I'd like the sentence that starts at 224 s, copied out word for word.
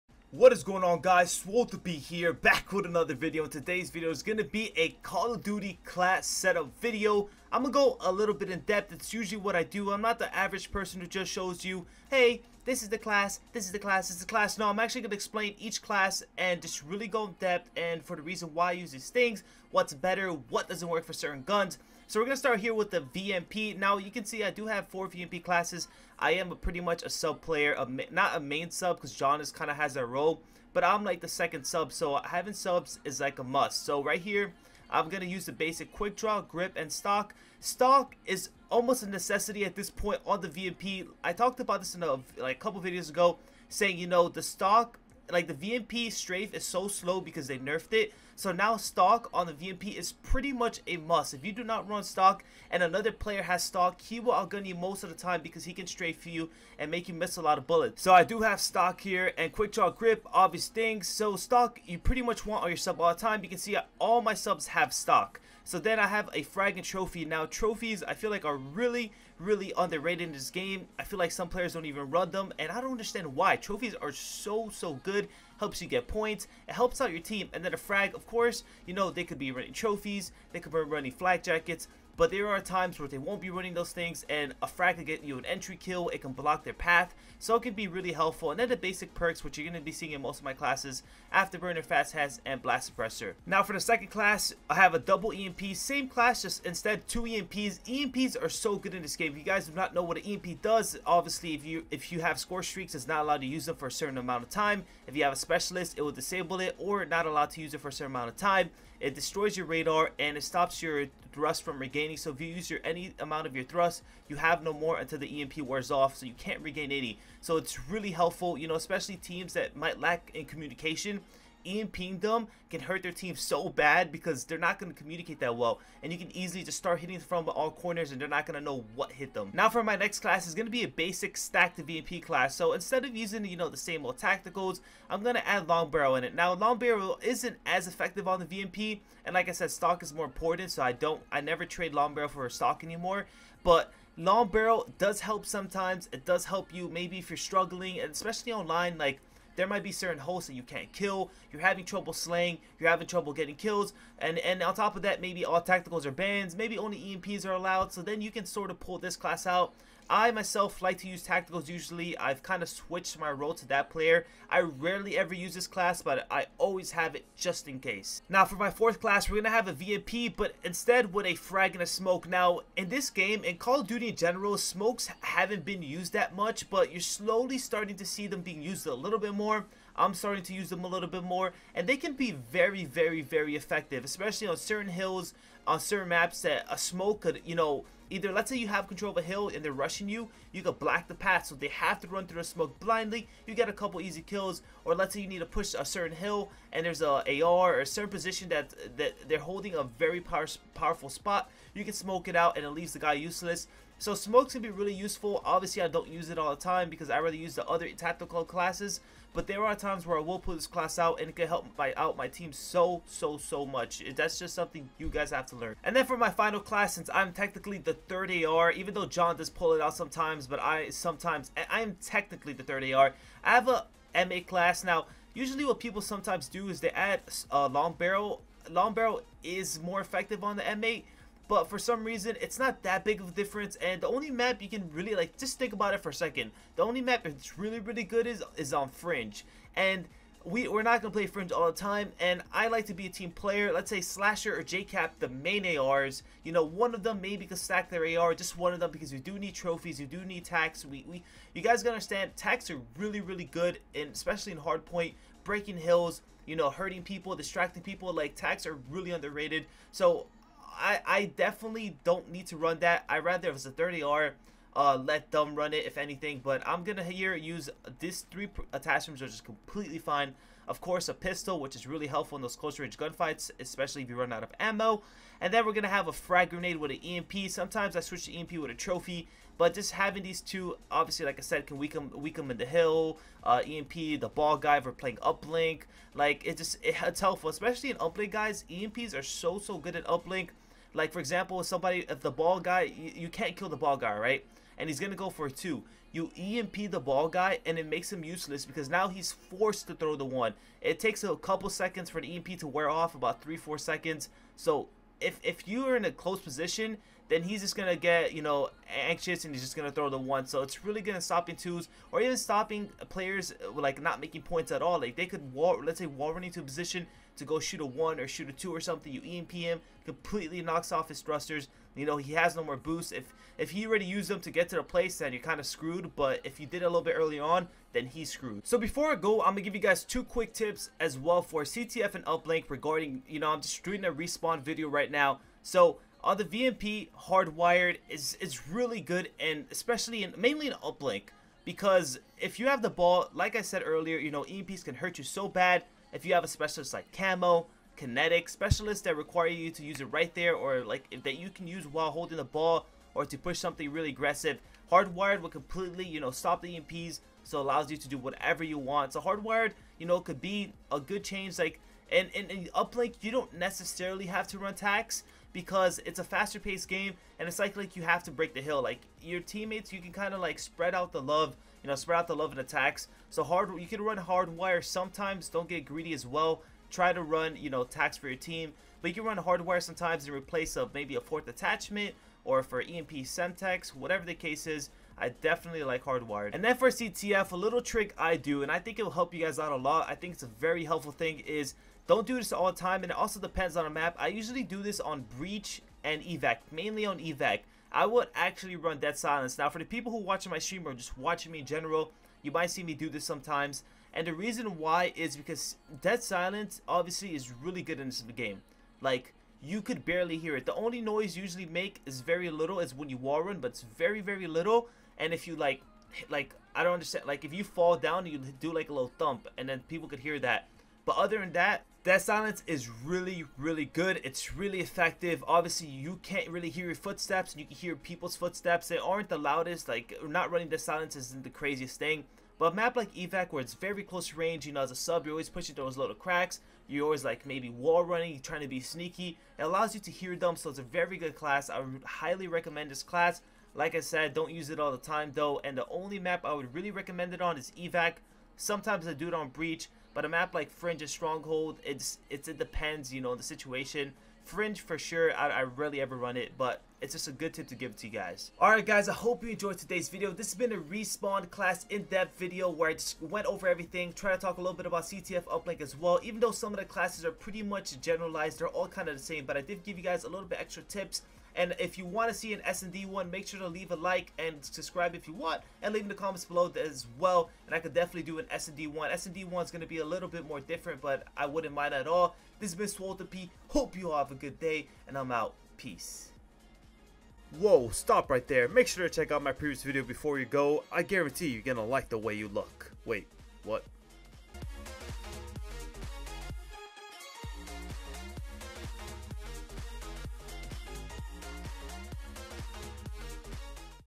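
Now, usually what people sometimes do is they add a uh, long barrel.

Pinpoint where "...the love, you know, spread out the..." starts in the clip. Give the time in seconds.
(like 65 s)
371 s.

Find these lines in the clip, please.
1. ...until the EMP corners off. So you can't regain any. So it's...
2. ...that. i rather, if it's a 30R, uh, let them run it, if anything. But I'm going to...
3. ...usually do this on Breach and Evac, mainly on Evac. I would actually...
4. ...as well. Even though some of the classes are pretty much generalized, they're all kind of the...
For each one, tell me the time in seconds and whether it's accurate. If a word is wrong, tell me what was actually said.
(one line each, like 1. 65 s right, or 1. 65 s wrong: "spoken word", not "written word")
1. 114 s wrong: "wears", not "corners"
2. 262 s right
3. 394 s right
4. 465 s right.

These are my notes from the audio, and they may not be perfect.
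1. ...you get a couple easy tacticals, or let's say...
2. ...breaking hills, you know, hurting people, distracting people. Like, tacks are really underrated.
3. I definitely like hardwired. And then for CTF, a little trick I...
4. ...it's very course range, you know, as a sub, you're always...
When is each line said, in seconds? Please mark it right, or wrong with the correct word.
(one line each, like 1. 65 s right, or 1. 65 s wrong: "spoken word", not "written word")
1. 193 s wrong: "kills", not "tacticals"
2. 255 s right
3. 385 s right
4. 433 s wrong: "close", not "course".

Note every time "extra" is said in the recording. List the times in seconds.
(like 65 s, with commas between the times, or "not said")
470 s.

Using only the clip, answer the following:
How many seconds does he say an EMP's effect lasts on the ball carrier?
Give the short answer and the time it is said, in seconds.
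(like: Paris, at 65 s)
3 to 4 seconds, at 303 s.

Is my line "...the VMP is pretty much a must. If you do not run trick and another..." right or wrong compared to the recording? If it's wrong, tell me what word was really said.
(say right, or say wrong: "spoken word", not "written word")
wrong: "stock", not "trick".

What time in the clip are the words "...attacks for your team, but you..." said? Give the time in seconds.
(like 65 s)
377 s.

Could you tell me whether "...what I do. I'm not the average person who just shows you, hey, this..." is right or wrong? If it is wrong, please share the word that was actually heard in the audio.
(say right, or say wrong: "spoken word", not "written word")
right.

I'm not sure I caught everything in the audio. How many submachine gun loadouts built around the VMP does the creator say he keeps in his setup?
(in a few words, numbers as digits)
4.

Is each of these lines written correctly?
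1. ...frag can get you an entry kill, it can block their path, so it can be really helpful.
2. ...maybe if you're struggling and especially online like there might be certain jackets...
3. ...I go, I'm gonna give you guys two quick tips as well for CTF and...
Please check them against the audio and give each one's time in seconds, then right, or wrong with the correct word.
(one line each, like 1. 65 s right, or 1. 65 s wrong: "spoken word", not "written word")
1. 84 s right
2. 146 s wrong: "hosts", not "jackets"
3. 329 s right.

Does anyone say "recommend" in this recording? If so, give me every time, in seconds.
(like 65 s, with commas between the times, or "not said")
442 s, 446 s.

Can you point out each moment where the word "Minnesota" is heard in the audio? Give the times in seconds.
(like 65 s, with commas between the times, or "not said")
not said.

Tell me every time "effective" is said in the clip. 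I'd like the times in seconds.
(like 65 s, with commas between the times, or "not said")
137 s, 183 s, 230 s, 424 s.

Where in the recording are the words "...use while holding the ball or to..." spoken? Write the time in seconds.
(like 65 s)
351 s.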